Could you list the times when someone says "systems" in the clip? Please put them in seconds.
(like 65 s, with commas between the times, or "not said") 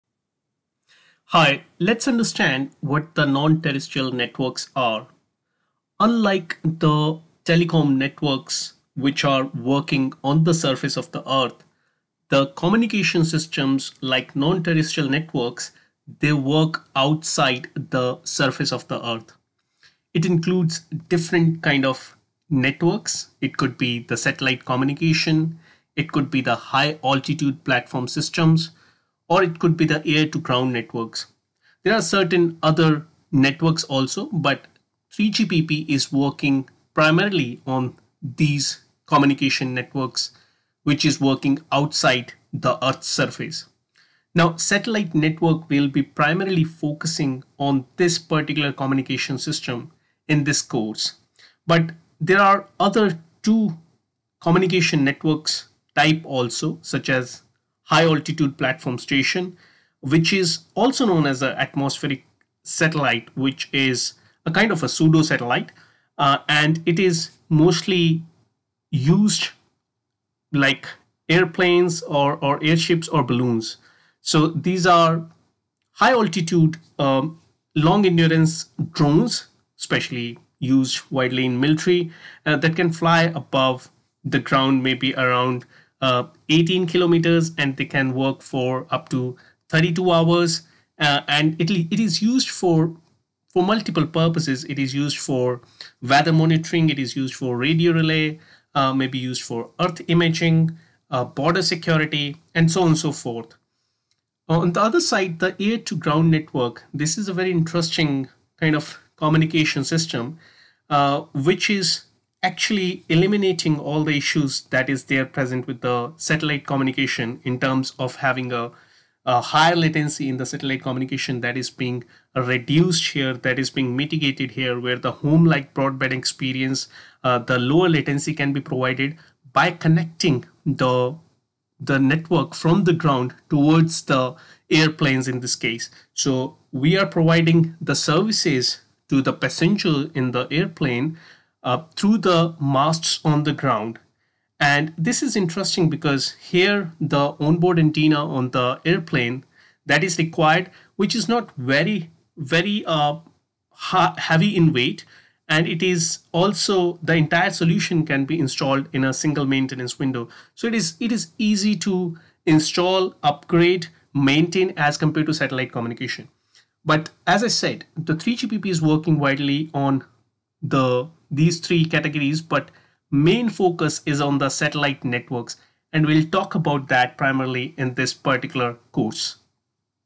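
13 s, 28 s, 49 s, 109 s.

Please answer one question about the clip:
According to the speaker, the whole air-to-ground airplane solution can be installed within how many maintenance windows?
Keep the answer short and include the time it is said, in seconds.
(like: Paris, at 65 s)
1, at 159 s.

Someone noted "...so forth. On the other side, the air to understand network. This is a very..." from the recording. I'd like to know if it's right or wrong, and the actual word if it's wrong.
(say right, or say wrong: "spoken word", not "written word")
wrong: "ground", not "understand".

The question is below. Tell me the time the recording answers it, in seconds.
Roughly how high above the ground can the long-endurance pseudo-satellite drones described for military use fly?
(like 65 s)
86 s.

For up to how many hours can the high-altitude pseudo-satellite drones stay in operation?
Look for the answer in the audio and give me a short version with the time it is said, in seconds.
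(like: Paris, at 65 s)
32 hours, at 89 s.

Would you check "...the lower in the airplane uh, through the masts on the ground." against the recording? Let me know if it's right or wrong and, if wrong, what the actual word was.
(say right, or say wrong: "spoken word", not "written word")
wrong: "passenger", not "lower".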